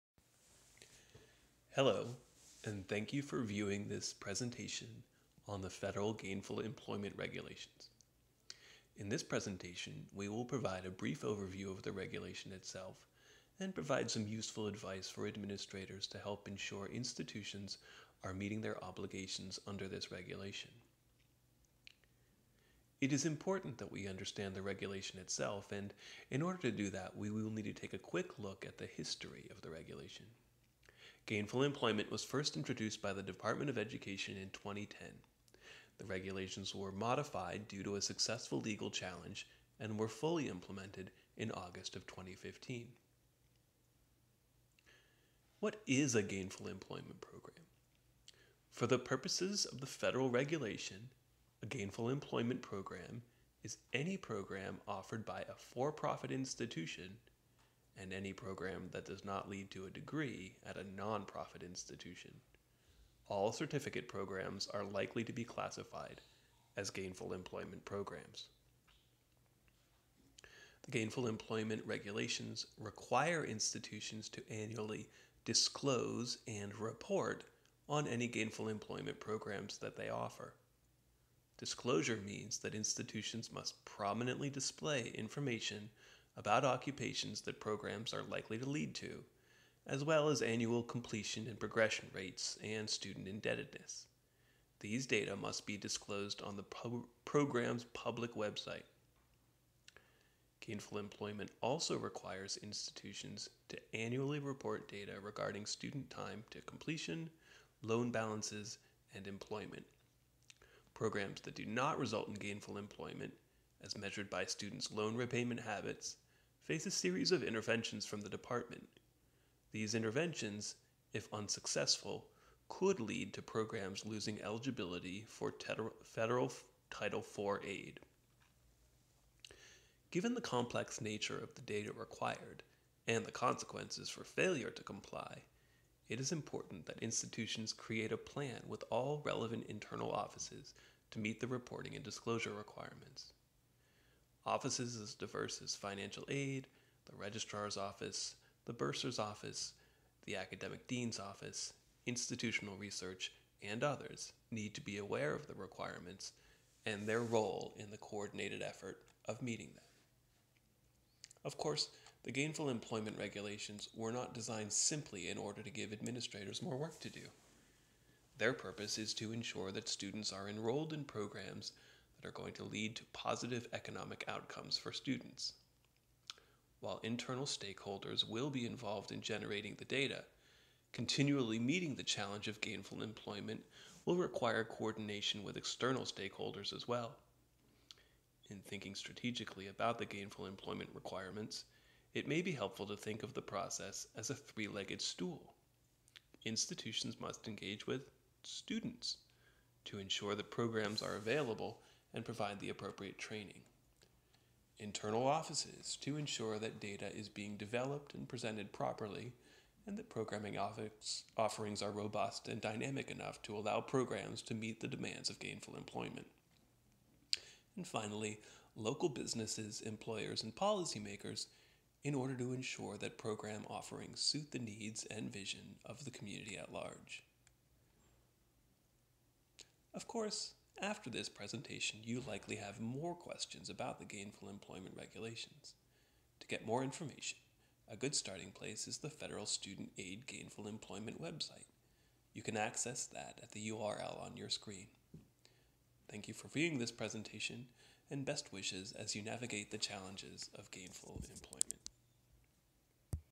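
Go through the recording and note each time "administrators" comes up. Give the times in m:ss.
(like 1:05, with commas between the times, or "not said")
0:15, 2:45.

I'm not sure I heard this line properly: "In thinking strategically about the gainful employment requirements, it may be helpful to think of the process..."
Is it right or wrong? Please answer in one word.
right.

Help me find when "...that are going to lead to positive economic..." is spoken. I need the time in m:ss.
2:52.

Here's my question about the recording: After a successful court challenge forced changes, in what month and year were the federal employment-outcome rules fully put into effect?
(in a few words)
August 2015.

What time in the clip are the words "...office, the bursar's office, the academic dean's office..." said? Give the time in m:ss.
2:27.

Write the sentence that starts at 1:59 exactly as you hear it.
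These interventions, if unsuccessful, could lead to programs losing eligibility for federal Title IV aid.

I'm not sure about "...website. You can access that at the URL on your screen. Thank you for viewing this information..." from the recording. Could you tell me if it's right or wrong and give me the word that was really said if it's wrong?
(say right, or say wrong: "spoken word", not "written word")
wrong: "presentation", not "information".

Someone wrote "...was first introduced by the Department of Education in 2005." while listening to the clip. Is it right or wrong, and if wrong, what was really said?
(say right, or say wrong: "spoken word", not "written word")
wrong: "2010", not "2005".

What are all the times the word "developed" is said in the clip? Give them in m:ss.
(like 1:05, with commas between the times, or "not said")
3:27.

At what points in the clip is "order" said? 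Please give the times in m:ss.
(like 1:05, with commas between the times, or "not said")
0:26, 2:45, 3:42.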